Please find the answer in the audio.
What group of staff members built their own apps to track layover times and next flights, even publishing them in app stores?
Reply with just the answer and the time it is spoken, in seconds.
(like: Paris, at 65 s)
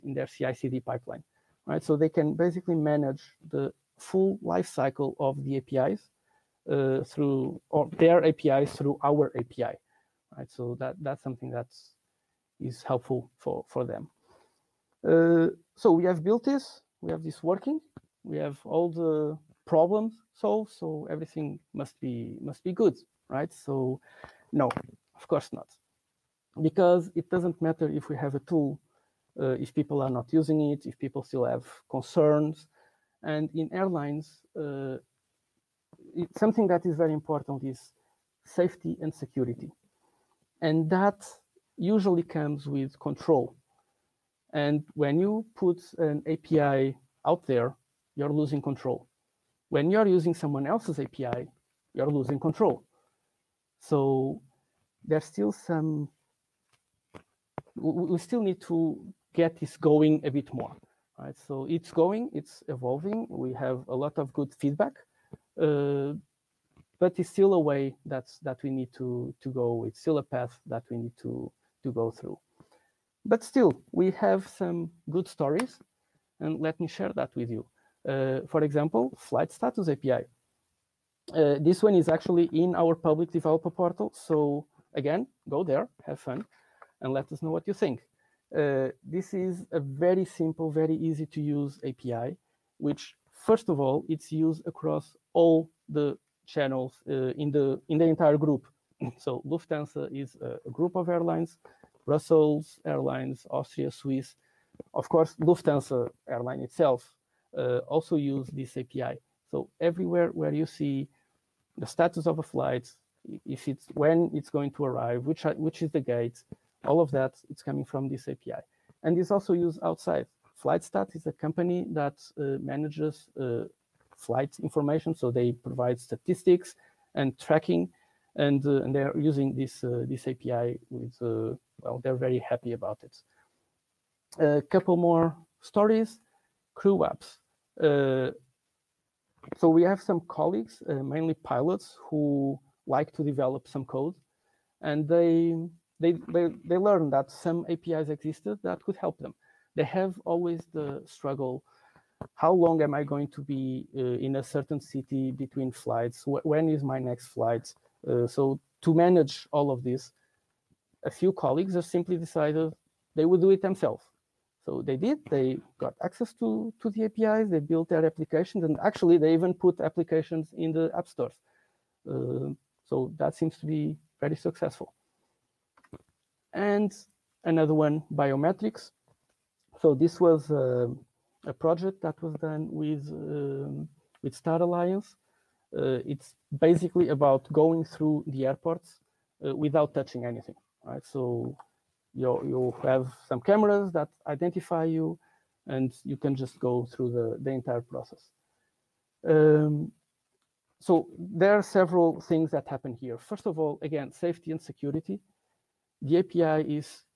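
pilots, at 141 s.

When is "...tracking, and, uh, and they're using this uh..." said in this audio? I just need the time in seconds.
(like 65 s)
127 s.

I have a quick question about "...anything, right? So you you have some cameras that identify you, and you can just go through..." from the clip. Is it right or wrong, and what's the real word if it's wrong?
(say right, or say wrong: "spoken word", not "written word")
right.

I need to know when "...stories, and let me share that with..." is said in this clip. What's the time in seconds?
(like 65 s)
75 s.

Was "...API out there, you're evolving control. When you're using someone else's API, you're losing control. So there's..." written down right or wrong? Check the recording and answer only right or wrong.
wrong.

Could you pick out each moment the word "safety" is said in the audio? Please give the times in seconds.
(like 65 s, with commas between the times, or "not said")
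38 s, 204 s.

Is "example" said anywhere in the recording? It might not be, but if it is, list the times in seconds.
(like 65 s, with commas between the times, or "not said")
78 s.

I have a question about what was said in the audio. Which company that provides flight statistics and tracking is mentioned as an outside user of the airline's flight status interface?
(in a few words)
FlightStats.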